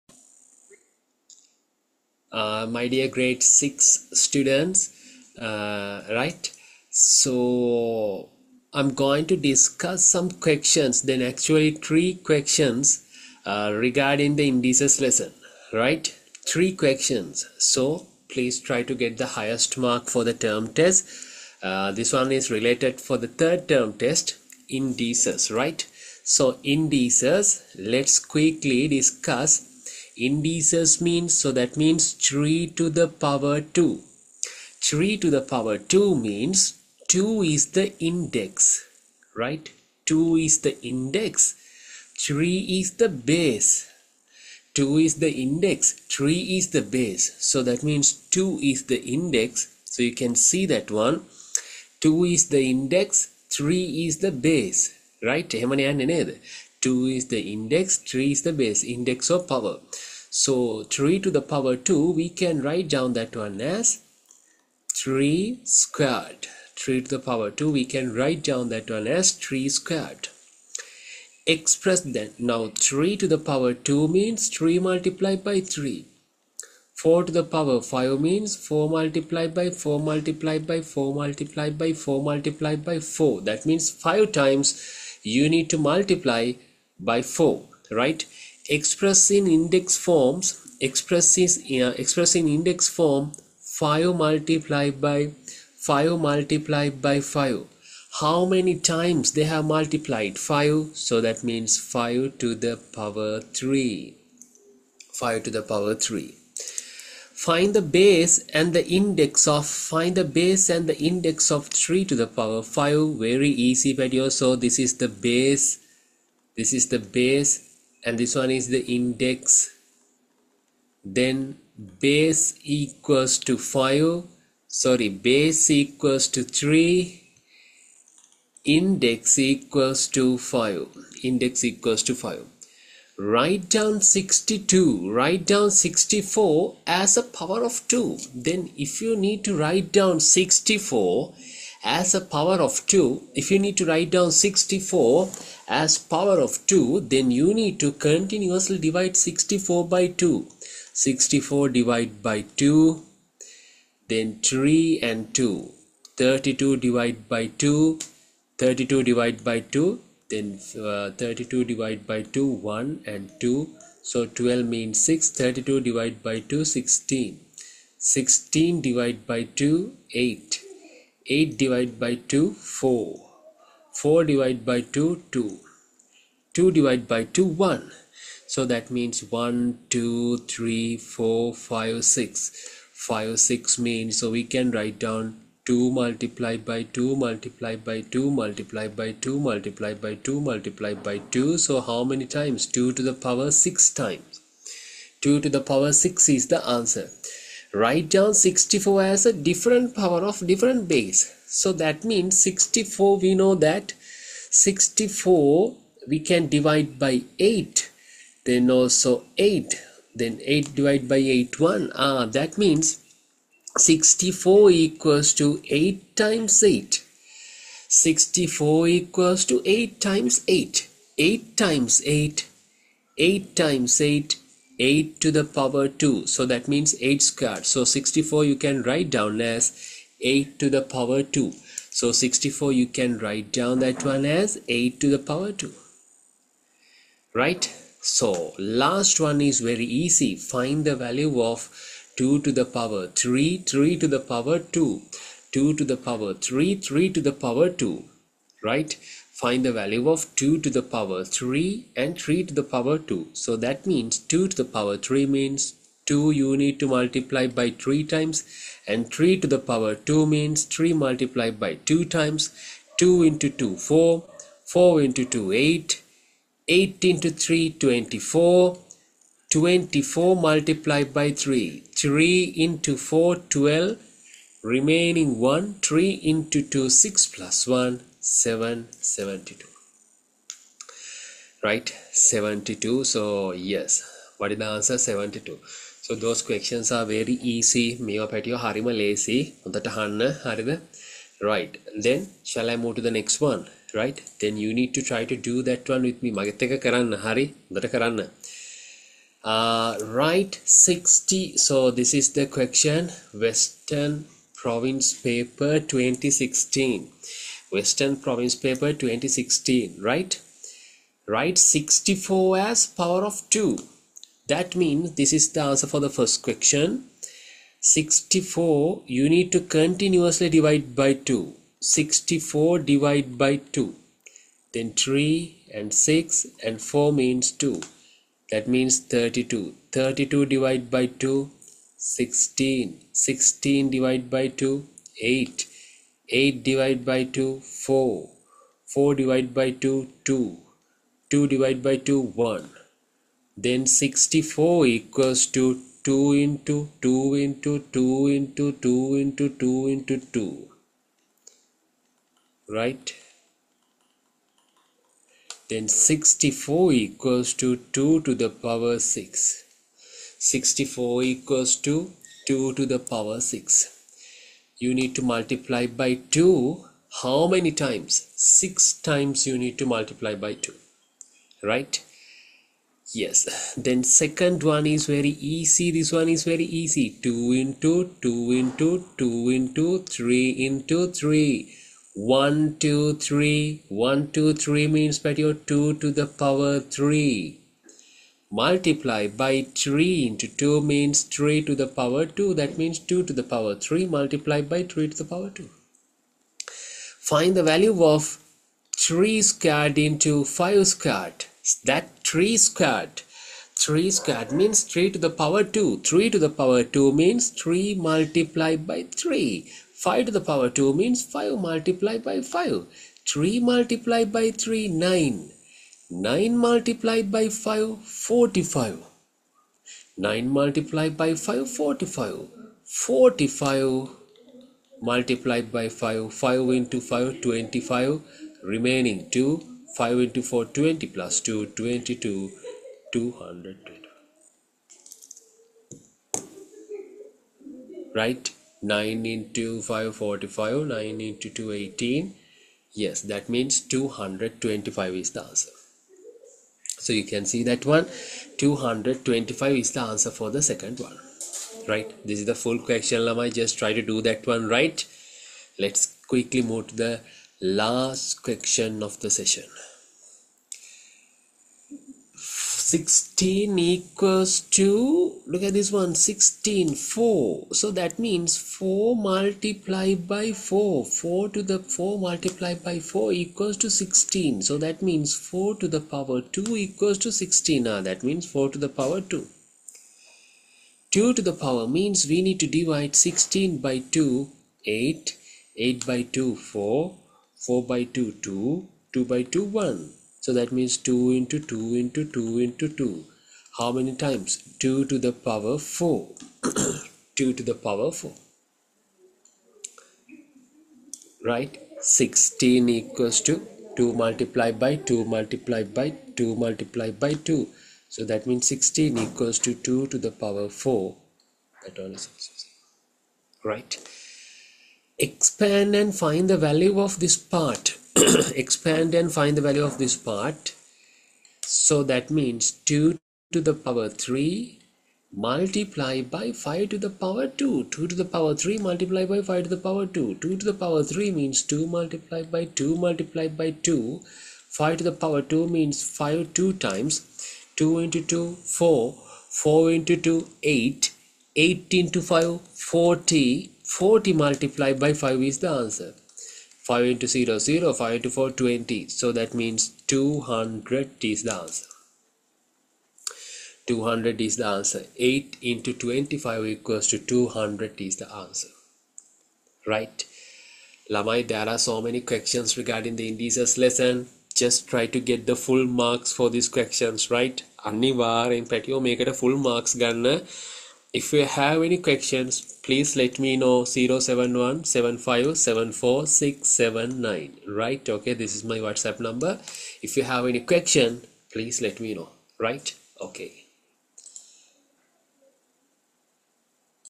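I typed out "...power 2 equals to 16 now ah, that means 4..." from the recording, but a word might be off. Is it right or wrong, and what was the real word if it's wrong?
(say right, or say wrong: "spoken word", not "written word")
right.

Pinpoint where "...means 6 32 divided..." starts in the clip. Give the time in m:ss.
2:44.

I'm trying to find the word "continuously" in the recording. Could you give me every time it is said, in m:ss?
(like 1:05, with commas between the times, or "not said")
2:27, 5:19.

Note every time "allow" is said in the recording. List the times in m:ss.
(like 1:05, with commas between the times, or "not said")
not said.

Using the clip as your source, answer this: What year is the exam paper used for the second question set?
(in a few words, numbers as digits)
2016.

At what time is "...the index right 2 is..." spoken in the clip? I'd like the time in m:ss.
0:37.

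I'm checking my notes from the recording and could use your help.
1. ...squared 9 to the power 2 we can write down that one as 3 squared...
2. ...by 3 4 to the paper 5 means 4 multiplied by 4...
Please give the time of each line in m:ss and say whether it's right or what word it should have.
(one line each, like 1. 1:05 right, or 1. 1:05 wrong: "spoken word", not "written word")
1. 1:05 wrong: "3", not "9"
2. 1:15 wrong: "power", not "paper".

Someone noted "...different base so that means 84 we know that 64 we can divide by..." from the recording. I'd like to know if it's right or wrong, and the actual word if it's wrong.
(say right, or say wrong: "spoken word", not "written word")
wrong: "64", not "84".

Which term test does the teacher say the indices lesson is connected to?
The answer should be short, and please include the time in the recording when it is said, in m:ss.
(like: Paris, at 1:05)
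third term test, at 0:23.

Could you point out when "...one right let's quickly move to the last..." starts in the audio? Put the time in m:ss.
7:34.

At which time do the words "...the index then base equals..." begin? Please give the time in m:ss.
1:58.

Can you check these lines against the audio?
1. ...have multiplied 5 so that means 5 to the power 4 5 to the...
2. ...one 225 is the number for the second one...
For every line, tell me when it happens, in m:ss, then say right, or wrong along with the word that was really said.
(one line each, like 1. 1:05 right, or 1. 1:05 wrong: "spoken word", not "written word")
1. 1:39 wrong: "3", not "4"
2. 7:27 wrong: "answer", not "number".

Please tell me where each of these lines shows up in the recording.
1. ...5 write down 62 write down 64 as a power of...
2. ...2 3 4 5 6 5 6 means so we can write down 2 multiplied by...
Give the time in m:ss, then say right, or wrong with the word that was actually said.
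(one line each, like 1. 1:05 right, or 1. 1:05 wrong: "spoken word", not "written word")
1. 2:12 right
2. 2:59 right.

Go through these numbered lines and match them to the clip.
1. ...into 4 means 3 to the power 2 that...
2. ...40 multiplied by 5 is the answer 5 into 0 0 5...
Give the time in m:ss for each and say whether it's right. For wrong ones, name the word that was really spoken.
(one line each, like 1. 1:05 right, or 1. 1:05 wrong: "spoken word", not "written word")
1. 6:30 wrong: "2", not "4"
2. 9:03 right.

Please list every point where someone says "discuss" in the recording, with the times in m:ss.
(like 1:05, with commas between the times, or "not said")
0:09, 0:28.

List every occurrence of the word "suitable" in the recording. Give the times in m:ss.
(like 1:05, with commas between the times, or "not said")
not said.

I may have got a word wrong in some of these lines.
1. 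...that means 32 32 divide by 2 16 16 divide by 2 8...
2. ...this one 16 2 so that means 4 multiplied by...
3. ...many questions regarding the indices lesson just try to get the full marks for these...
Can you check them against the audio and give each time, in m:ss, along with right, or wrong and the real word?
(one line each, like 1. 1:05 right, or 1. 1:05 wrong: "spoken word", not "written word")
1. 5:28 right
2. 7:45 wrong: "4", not "2"
3. 9:22 right.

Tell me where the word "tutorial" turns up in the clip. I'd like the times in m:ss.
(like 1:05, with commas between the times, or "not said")
not said.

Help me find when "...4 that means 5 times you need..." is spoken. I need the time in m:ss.
1:23.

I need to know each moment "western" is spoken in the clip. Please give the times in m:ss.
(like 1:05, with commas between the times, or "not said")
5:03, 5:07.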